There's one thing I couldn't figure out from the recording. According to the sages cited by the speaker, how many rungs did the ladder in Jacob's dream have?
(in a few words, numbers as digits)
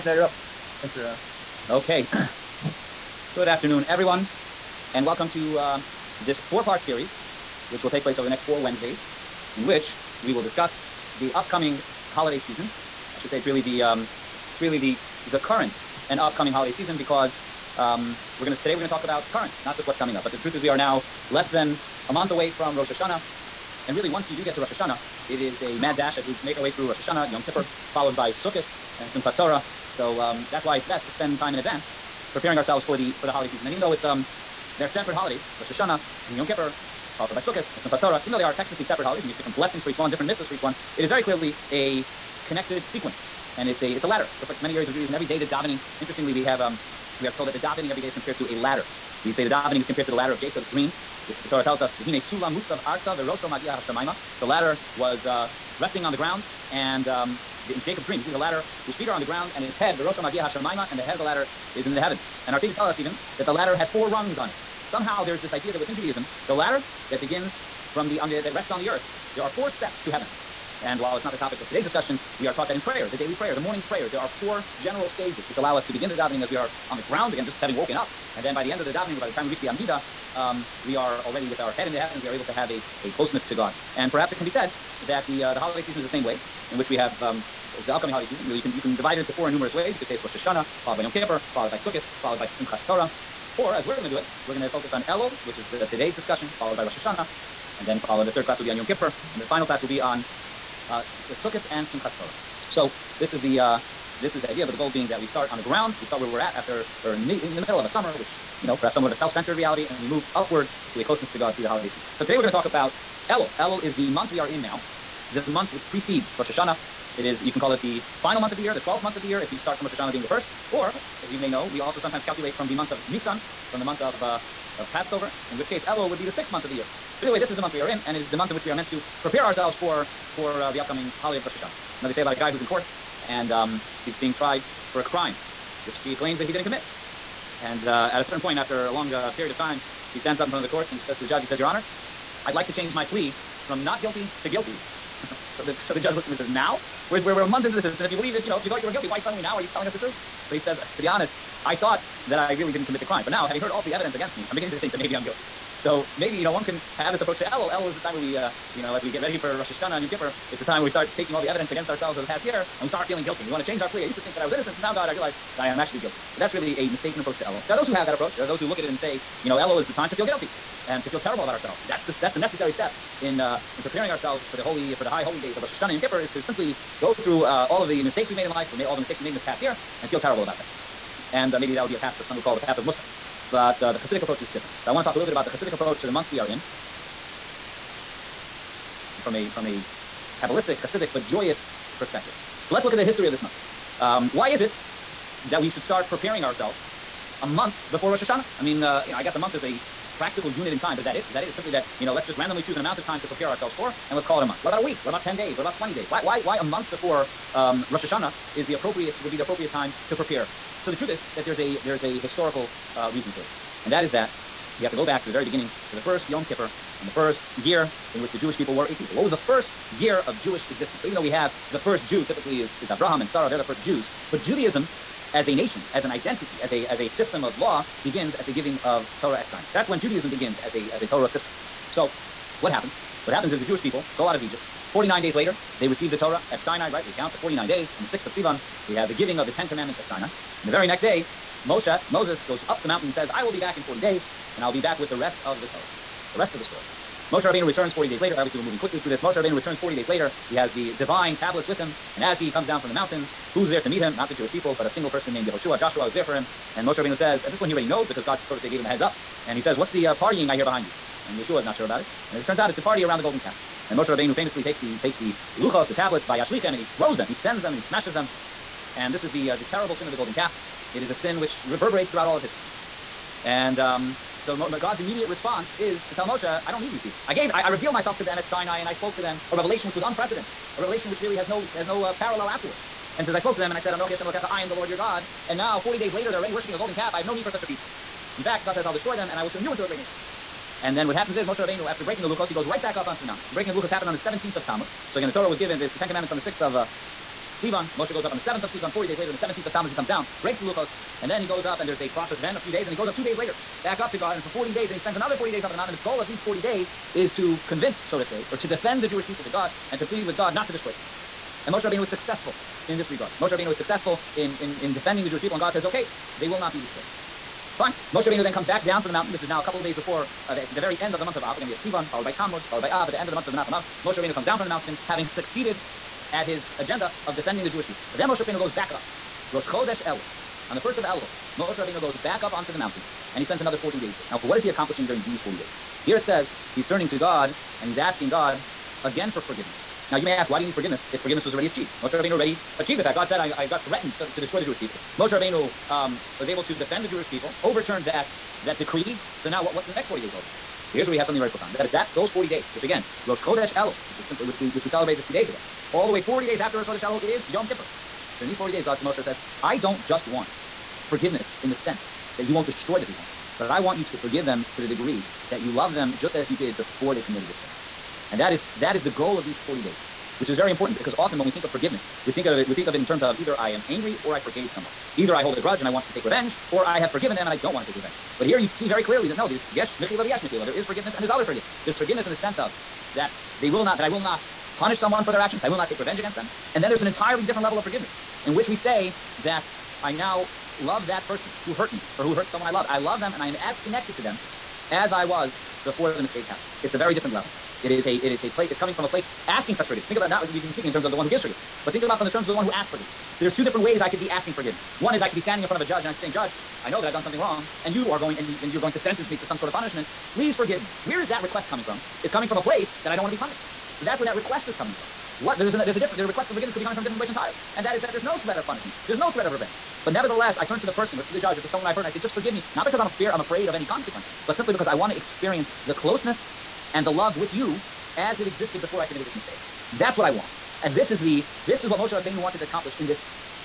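4.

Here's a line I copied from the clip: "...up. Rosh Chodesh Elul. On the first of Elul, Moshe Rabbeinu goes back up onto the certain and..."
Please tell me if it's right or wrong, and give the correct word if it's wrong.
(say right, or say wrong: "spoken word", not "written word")
wrong: "mountain", not "certain".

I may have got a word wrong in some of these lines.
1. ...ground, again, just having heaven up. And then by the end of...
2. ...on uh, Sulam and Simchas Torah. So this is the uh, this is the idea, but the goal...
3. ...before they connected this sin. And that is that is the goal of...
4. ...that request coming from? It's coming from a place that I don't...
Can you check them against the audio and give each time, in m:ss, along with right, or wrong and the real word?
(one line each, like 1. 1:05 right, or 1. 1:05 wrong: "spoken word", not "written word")
1. 1:17 wrong: "woken", not "heaven"
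2. 1:39 wrong: "Sukkot", not "Sulam"
3. 6:06 wrong: "committed", not "connected"
4. 6:51 right.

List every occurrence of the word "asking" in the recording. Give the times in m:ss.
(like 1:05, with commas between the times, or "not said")
5:37, 6:39, 6:44.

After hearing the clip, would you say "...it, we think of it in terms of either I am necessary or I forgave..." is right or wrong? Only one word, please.
wrong.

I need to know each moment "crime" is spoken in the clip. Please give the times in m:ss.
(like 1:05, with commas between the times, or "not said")
2:15, 2:33.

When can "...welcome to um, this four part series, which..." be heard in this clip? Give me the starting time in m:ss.
0:05.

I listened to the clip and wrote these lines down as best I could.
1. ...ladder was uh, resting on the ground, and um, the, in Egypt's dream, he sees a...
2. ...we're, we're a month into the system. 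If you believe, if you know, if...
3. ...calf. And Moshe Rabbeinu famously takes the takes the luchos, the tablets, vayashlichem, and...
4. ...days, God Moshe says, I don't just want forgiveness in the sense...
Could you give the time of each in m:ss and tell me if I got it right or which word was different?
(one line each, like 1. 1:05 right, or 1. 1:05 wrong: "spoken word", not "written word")
1. 0:54 wrong: "Jacob", not "Egypt"
2. 2:27 right
3. 4:23 right
4. 5:58 right.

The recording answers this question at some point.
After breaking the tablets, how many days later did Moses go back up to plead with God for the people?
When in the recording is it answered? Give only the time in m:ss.
5:03.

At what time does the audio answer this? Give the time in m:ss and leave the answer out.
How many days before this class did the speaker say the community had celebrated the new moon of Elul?
5:55.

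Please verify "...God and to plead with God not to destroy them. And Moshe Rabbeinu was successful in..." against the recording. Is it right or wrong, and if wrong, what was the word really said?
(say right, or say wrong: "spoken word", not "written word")
right.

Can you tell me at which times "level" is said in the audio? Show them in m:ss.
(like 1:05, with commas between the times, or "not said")
6:27, 6:37.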